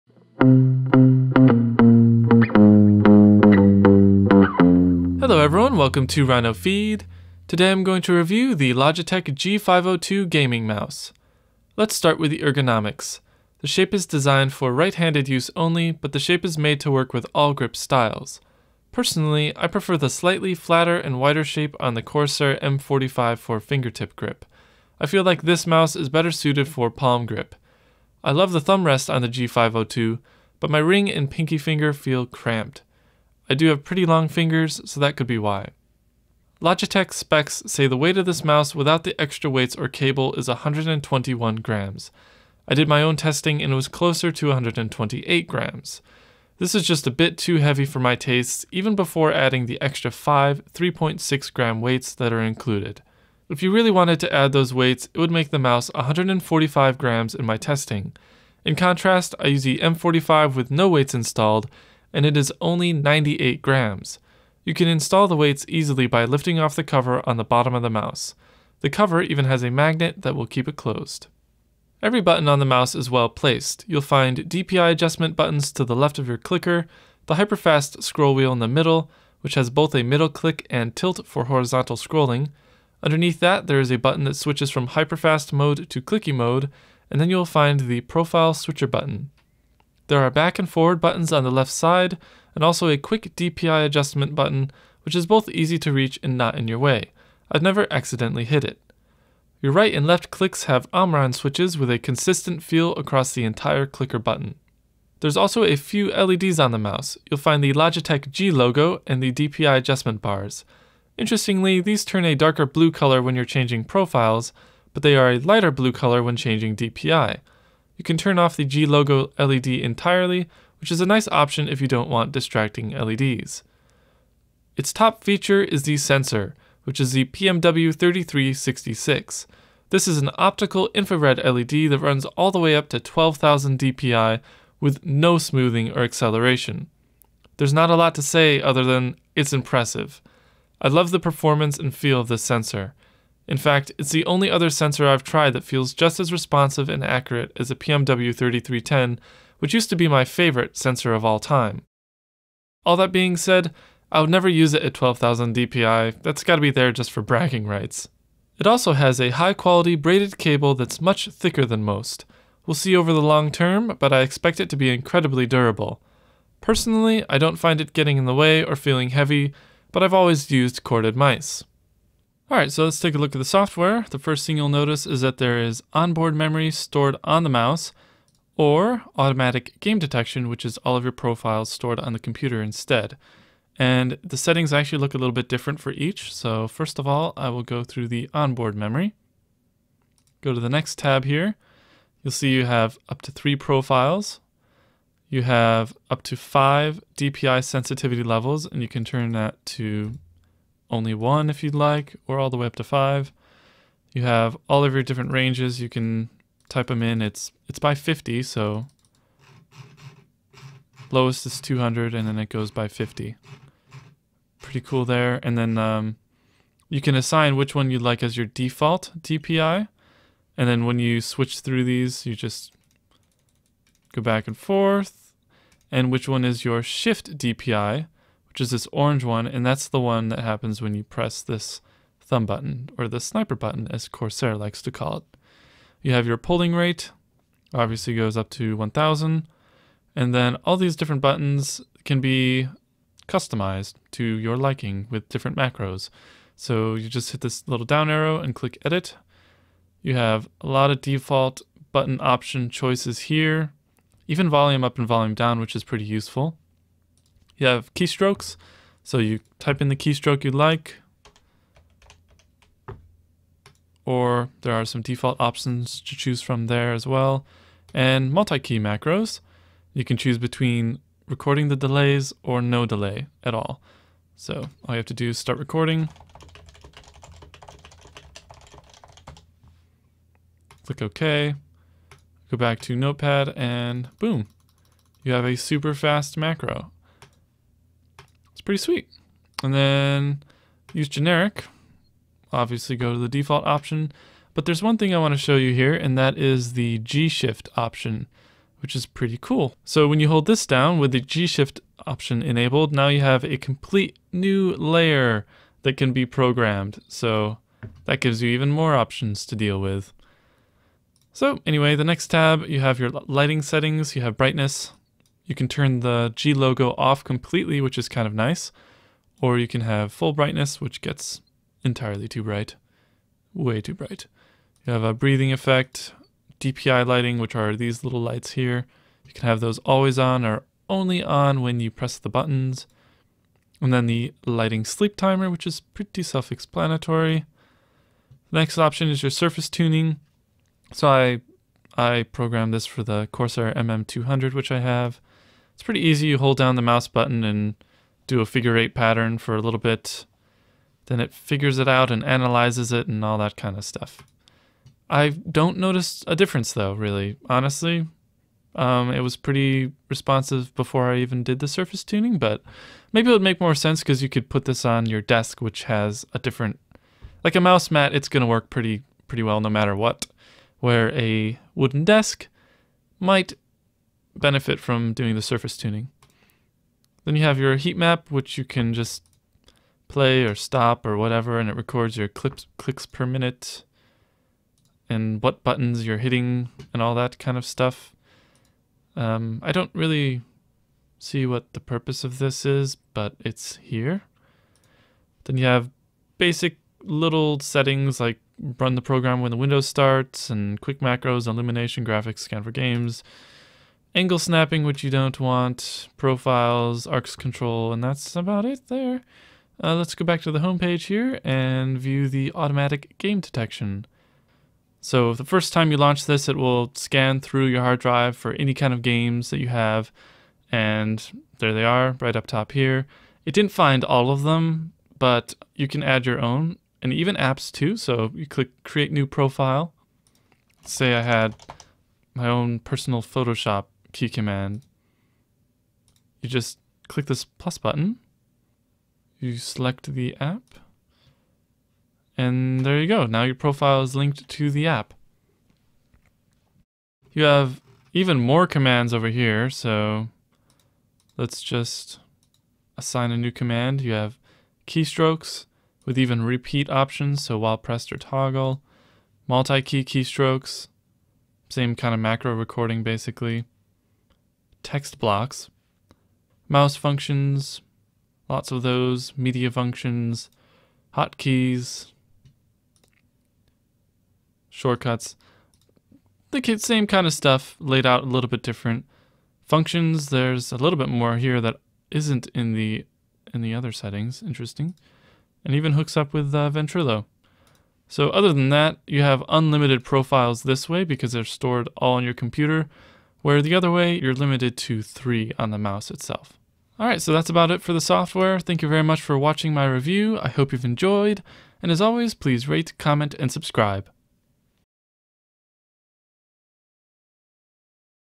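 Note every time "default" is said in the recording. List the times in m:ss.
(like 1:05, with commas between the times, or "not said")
3:38, 4:10, 4:25, 4:53.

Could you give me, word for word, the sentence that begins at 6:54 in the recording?
So the first time you launch this, it will scan through your hard drive for any kind of games that you have.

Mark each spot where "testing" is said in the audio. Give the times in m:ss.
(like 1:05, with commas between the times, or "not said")
0:43, 0:57.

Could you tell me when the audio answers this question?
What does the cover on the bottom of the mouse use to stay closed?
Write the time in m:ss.
1:09.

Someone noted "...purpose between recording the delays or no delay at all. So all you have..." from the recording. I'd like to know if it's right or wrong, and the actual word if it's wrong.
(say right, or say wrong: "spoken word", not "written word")
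wrong: "choose", not "purpose".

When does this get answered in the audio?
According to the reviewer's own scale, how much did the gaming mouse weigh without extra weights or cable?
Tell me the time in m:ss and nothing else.
0:44.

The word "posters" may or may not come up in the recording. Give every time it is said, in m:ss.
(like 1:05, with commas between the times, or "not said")
not said.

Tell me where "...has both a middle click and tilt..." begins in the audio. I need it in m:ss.
1:19.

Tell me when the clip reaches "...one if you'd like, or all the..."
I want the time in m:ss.
3:21.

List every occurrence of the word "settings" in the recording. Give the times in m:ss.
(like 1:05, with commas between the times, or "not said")
3:04, 5:13, 6:37, 8:03.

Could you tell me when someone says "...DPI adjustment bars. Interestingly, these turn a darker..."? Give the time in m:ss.
1:49.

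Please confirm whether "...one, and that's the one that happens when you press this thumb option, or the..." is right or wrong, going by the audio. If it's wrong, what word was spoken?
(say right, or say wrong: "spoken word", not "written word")
wrong: "button", not "option".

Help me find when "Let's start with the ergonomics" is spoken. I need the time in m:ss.
0:11.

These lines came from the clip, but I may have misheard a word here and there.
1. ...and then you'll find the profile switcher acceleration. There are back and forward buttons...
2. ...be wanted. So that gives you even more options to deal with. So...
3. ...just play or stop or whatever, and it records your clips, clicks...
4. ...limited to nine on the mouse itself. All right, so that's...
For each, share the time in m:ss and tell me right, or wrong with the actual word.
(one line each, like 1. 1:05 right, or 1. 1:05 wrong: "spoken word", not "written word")
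1. 1:27 wrong: "button", not "acceleration"
2. 5:06 wrong: "programmed", not "wanted"
3. 6:18 right
4. 8:14 wrong: "three", not "nine".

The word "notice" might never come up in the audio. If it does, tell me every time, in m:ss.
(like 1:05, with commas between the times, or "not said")
2:54, 5:55.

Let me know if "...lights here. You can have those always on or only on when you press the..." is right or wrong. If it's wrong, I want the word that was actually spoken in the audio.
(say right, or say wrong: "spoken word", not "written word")
right.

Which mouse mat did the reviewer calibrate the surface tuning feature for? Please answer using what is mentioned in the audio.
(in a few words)
Corsair MM200.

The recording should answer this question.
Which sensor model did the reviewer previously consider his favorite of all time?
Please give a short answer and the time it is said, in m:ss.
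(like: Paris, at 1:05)
PMW3310, at 2:27.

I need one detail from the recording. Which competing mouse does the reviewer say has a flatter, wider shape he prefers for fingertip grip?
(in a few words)
Corsair M45.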